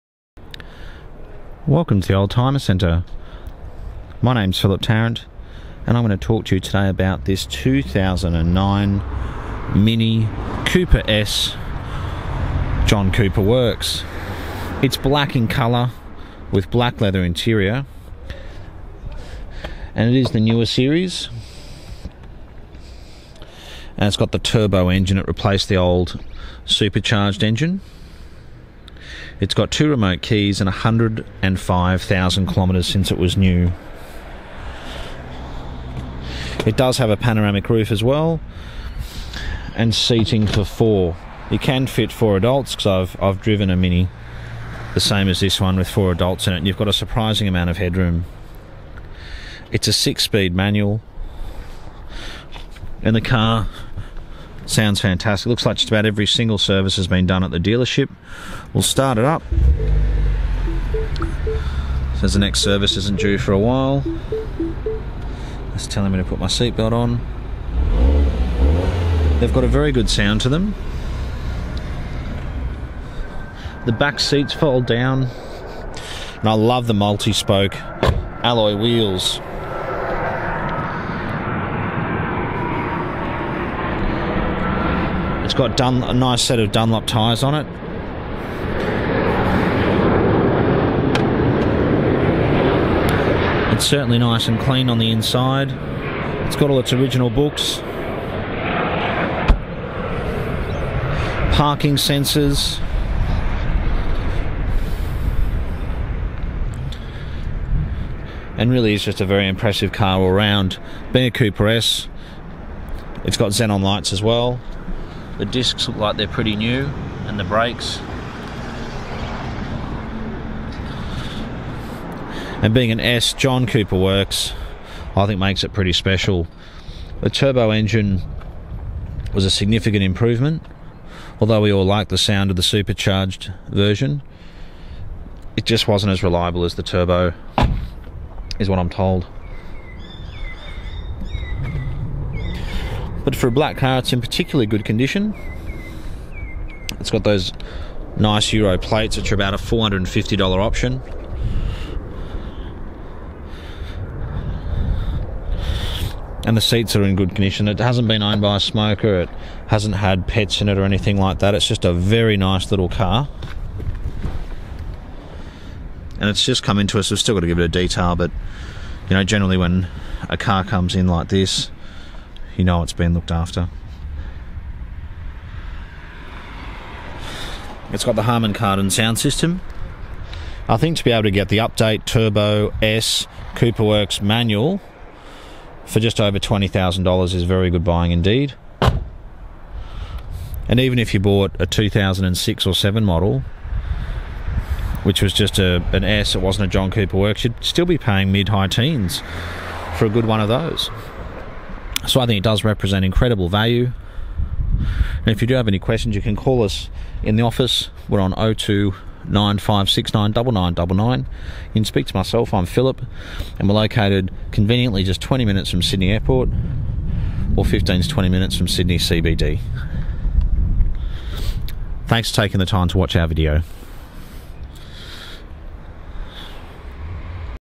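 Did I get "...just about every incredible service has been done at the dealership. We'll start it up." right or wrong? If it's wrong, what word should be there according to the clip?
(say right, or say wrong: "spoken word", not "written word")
wrong: "single", not "incredible".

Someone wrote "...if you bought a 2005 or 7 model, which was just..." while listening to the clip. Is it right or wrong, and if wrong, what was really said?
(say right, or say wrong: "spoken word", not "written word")
wrong: "2006", not "2005".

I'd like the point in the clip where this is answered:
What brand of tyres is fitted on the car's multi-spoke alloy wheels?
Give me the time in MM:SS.
01:26.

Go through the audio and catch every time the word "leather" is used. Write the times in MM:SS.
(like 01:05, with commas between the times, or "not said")
00:16.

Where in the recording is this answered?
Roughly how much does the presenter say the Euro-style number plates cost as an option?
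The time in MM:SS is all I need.
02:29.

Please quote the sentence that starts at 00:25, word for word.
It replaced the old supercharged engine.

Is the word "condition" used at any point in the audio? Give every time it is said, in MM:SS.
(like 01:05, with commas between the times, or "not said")
02:24, 02:37.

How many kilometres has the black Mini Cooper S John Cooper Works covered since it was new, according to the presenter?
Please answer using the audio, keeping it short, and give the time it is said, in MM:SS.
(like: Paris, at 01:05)
105,000, at 00:30.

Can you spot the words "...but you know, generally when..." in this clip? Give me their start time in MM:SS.
02:48.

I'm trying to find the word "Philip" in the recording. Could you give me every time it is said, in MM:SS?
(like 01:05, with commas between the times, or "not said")
00:04, 03:32.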